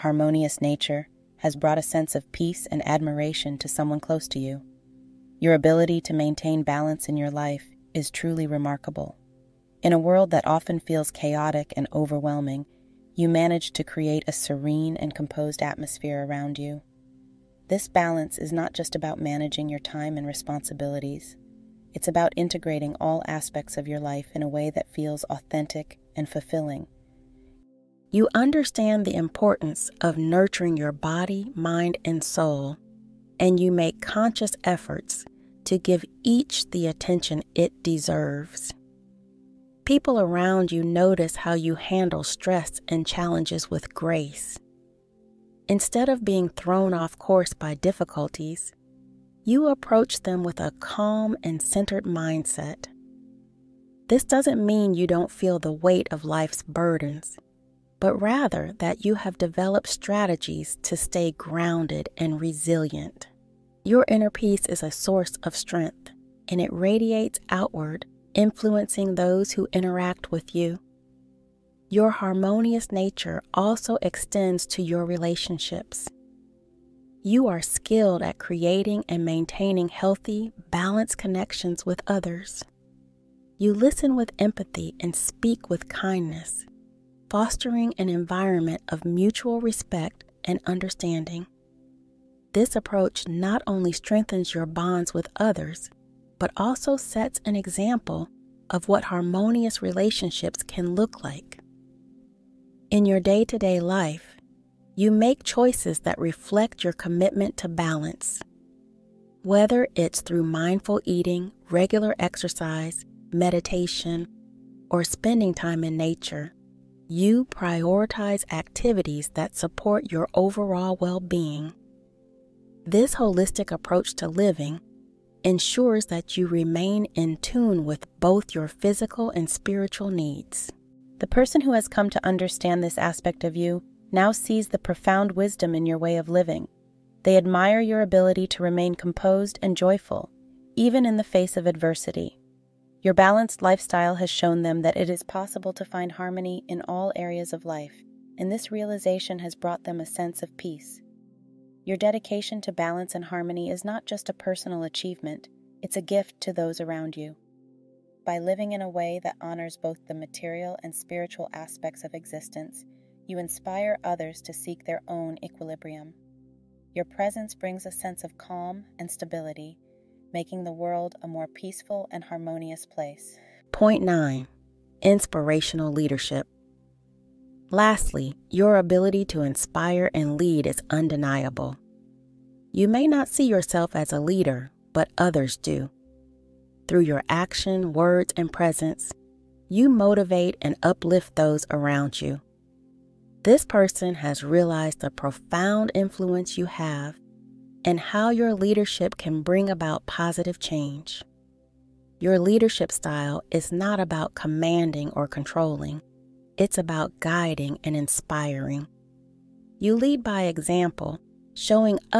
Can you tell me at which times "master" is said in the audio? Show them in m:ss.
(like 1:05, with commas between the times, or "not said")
not said.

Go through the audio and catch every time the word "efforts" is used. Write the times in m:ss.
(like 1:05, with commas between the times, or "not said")
0:34.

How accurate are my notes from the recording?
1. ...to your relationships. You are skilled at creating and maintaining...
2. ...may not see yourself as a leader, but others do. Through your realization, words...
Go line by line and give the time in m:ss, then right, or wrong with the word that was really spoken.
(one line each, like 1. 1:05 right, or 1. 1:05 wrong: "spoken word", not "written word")
1. 1:14 right
2. 3:02 wrong: "action", not "realization".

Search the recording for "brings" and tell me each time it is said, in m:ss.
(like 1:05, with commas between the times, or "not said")
2:47, 3:19.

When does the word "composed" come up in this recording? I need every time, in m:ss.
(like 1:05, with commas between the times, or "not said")
0:15, 2:18.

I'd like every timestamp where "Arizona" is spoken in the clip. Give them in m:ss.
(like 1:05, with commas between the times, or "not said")
not said.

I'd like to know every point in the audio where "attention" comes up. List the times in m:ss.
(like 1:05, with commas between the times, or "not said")
0:36.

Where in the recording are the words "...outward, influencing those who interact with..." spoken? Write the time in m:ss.
1:07.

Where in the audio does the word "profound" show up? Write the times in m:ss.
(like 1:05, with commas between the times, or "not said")
2:14, 3:15.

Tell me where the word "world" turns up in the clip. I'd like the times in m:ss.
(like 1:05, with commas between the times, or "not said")
0:09, 2:50.